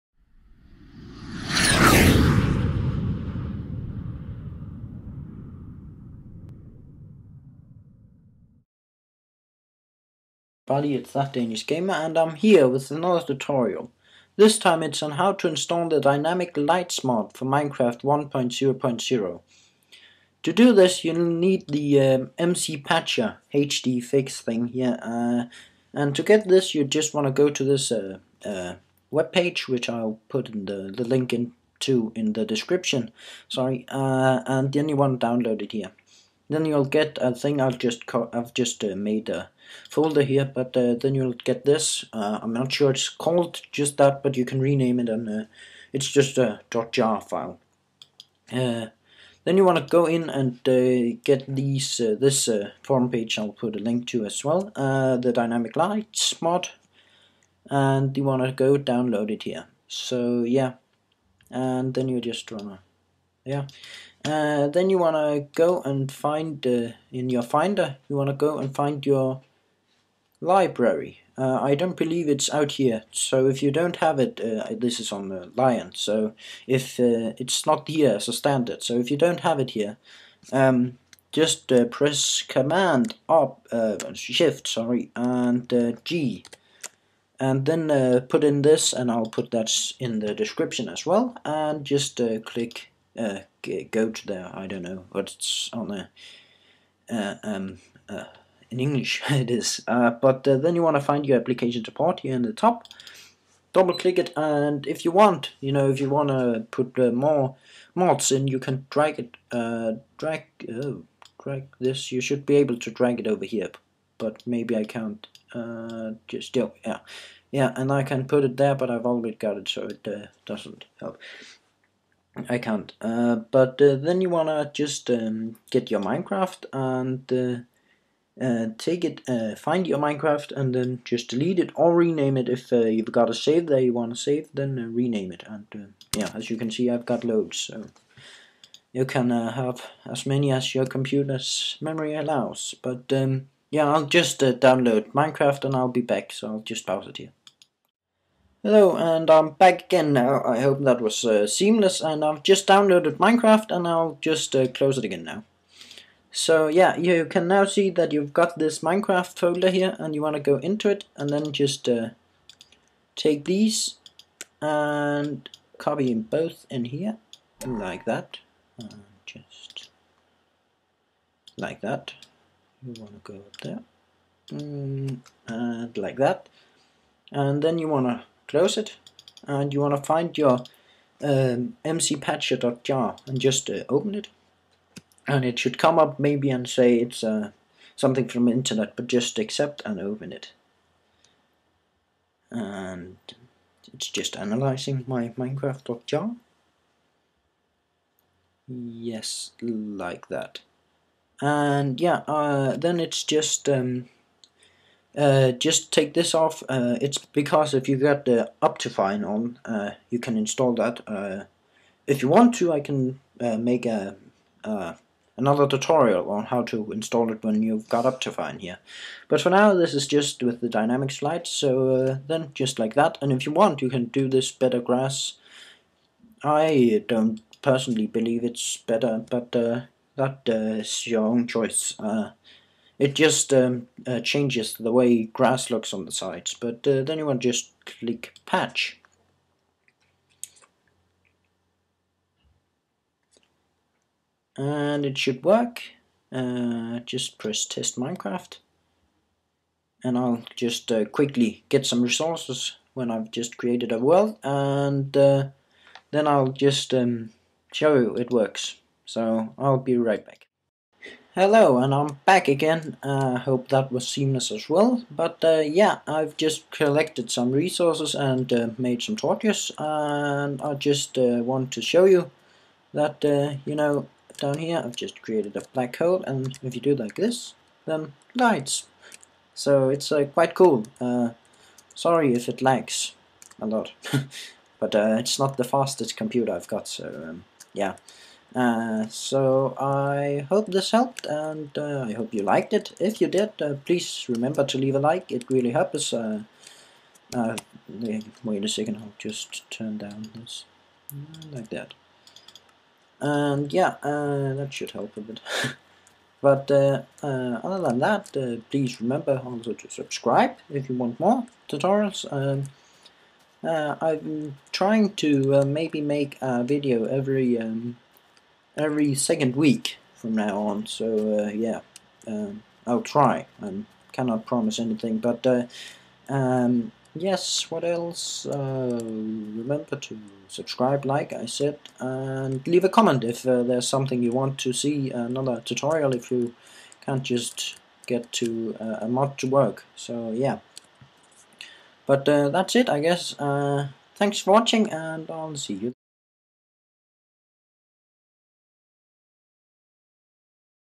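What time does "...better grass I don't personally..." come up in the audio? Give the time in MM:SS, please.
03:44.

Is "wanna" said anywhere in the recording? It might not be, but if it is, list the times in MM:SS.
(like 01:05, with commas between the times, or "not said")
01:02, 02:04, 02:13.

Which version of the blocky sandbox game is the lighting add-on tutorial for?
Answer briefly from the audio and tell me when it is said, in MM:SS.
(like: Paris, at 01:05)
1.0.0, at 00:17.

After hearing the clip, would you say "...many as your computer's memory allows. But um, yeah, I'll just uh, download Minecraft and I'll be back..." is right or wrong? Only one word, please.
right.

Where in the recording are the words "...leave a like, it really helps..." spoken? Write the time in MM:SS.
04:54.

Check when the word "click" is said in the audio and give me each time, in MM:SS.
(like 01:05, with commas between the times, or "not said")
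01:32, 01:43, 03:57.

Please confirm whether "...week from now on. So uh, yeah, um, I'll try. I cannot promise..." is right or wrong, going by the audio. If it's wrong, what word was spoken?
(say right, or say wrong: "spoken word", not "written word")
right.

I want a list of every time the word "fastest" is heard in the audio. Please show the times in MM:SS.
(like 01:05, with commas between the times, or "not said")
04:45.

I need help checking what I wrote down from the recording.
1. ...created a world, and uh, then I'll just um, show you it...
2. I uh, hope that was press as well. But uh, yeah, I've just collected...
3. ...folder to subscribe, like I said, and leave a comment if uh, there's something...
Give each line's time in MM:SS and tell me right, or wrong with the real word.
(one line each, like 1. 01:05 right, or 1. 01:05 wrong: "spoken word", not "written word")
1. 04:13 right
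2. 04:23 wrong: "seamless", not "press"
3. 05:29 wrong: "remember", not "folder".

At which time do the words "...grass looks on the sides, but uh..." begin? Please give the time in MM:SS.
03:55.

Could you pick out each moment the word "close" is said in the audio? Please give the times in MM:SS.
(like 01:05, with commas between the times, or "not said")
02:34, 02:58.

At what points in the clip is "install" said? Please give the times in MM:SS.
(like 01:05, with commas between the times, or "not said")
00:15, 03:30, 03:36.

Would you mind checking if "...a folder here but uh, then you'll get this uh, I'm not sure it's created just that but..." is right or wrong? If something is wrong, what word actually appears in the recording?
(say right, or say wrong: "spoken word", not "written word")
wrong: "called", not "created".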